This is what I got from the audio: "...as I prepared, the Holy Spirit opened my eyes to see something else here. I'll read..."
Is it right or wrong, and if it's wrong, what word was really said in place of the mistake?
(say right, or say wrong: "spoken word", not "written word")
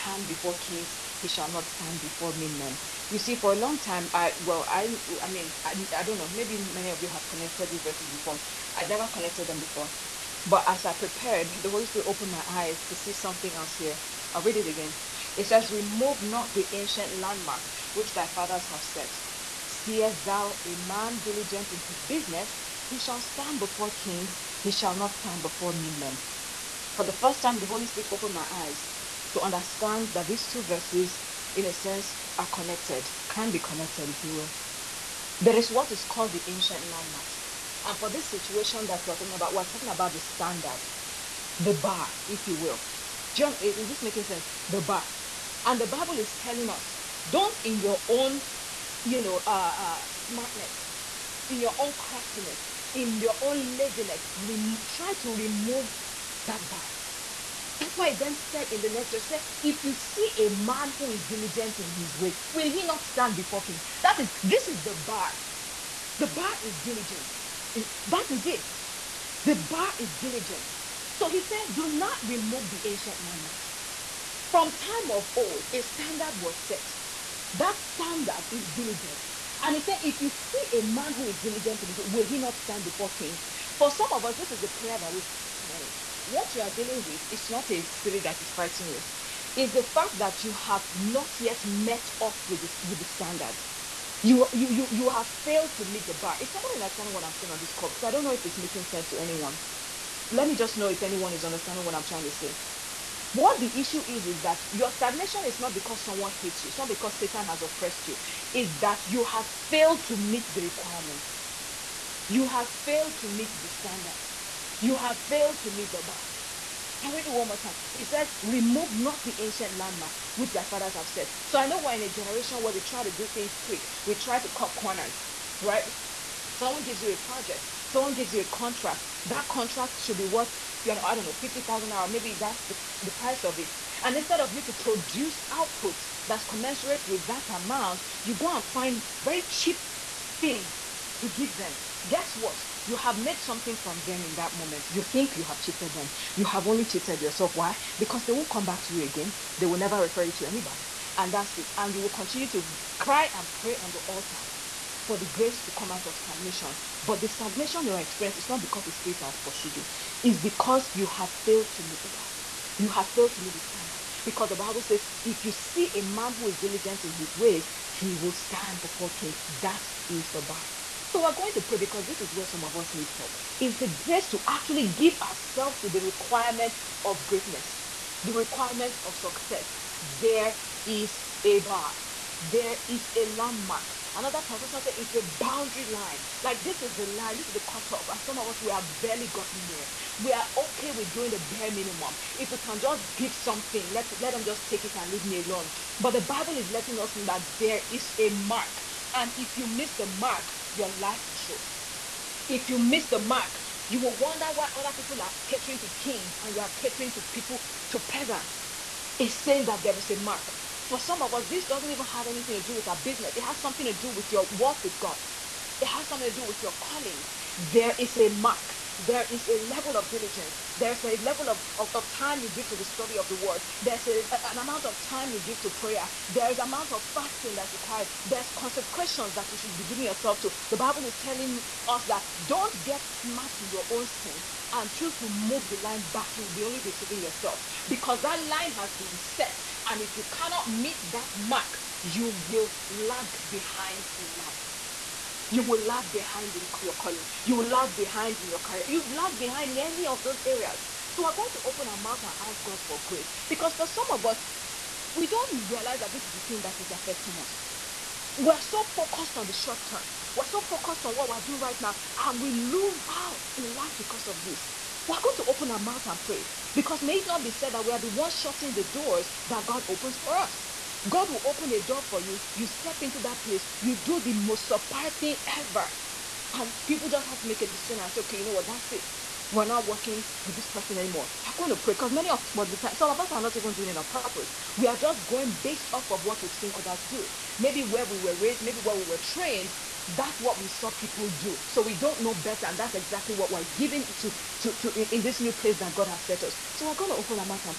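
right.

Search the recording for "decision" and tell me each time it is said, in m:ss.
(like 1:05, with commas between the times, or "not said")
4:37.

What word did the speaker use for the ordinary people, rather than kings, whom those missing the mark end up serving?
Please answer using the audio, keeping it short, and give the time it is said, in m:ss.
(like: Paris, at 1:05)
Peasants, at 3:28.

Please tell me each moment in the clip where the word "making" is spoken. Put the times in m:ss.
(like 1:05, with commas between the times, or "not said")
0:44, 1:38.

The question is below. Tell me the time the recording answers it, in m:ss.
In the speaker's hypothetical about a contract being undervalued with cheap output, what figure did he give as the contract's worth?
2:11.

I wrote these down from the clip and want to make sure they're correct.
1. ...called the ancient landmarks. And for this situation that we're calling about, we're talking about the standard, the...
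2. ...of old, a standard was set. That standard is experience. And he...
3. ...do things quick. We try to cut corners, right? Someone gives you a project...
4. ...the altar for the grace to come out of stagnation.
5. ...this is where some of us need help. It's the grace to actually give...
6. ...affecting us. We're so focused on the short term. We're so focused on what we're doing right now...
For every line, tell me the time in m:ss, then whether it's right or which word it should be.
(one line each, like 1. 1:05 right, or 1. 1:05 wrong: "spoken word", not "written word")
1. 0:36 wrong: "talking", not "calling"
2. 1:15 wrong: "diligence", not "experience"
3. 2:03 right
4. 2:33 right
5. 2:52 right
6. 4:16 right.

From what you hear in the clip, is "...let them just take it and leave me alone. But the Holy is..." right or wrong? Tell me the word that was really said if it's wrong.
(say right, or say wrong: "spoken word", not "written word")
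wrong: "Bible", not "Holy".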